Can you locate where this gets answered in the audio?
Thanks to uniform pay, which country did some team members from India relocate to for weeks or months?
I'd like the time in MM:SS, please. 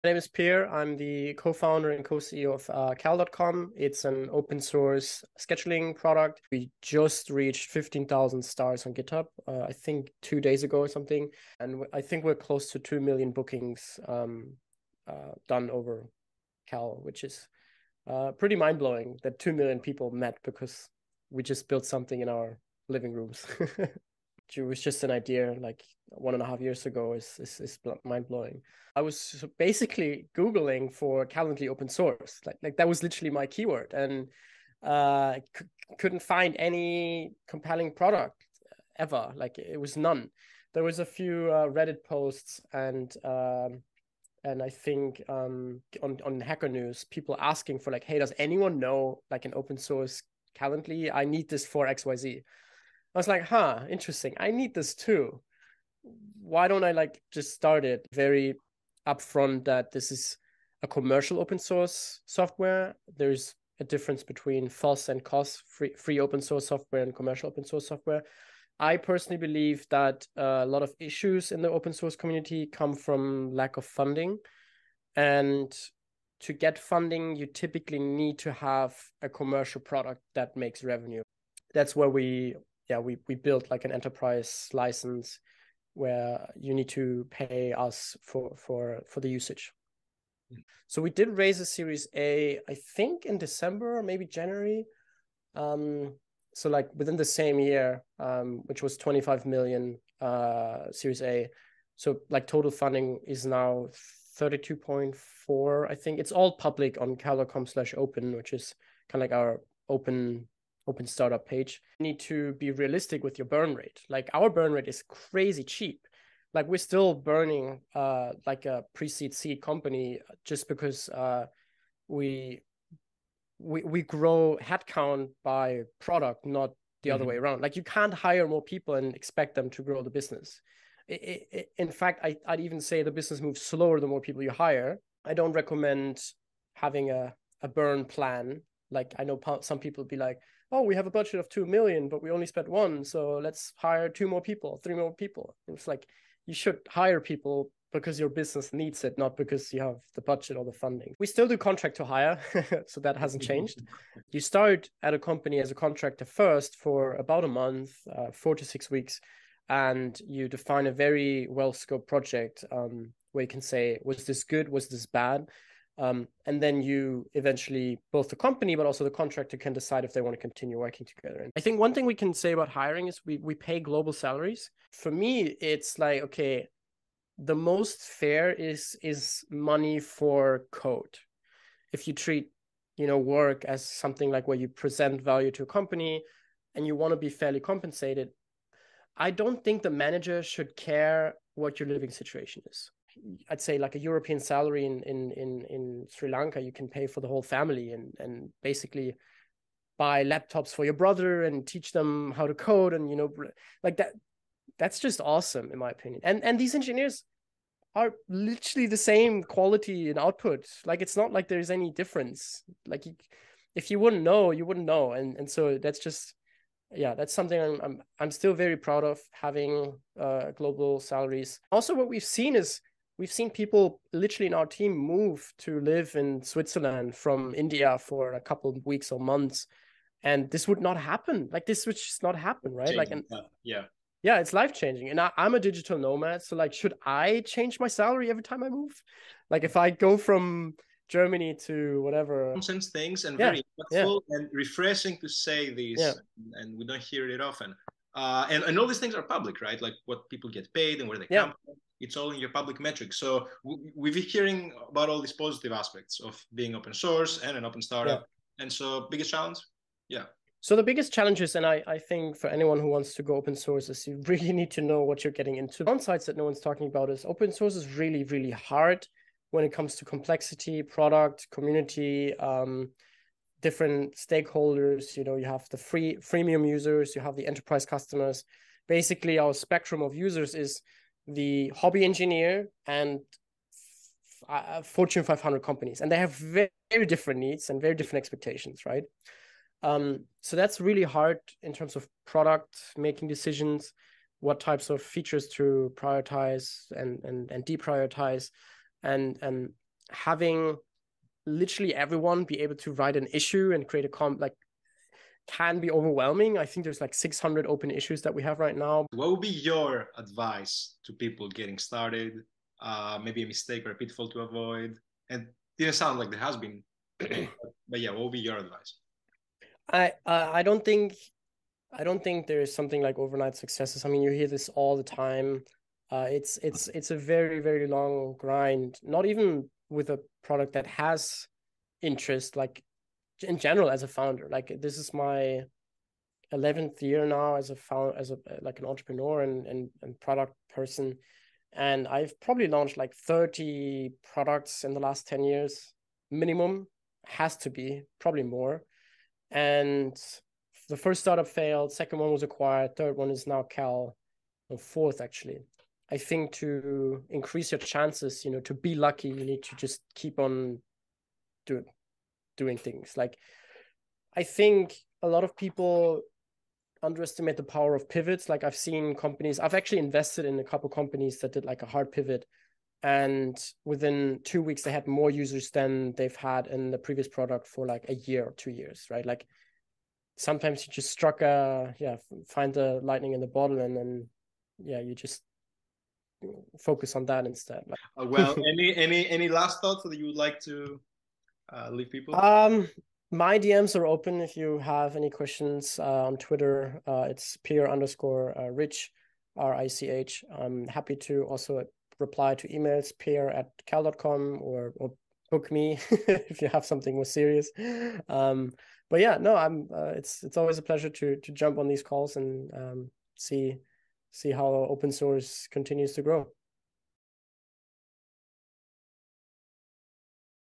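03:46.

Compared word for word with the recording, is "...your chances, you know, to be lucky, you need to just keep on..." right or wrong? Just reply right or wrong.
right.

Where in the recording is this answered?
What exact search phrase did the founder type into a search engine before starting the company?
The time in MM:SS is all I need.
00:31.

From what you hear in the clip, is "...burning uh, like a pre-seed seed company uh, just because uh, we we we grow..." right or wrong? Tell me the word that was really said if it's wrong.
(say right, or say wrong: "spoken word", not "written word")
right.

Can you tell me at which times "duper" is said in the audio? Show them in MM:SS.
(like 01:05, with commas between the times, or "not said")
not said.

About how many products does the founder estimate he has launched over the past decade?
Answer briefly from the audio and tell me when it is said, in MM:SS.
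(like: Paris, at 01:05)
30, at 05:43.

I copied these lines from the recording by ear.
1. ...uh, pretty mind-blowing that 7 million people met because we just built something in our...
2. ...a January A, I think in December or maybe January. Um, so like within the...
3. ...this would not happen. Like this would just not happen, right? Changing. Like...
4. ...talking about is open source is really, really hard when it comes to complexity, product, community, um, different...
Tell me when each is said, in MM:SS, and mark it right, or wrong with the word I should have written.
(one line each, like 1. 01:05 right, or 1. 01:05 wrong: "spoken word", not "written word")
1. 00:18 wrong: "2", not "7"
2. 01:31 wrong: "Series", not "January"
3. 03:50 right
4. 04:26 right.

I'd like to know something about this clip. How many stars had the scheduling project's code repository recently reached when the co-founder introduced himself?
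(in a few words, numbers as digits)
15,000.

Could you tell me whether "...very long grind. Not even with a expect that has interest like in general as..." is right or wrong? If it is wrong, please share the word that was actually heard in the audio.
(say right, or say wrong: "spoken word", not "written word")
wrong: "product", not "expect".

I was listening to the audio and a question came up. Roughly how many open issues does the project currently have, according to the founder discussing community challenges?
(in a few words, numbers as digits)
600.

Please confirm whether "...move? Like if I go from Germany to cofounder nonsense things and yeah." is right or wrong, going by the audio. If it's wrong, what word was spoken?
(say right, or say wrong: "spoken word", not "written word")
wrong: "whatever", not "cofounder".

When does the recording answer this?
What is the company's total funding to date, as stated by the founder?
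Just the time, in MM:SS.
01:44.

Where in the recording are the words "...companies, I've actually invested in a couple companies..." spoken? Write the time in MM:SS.
06:09.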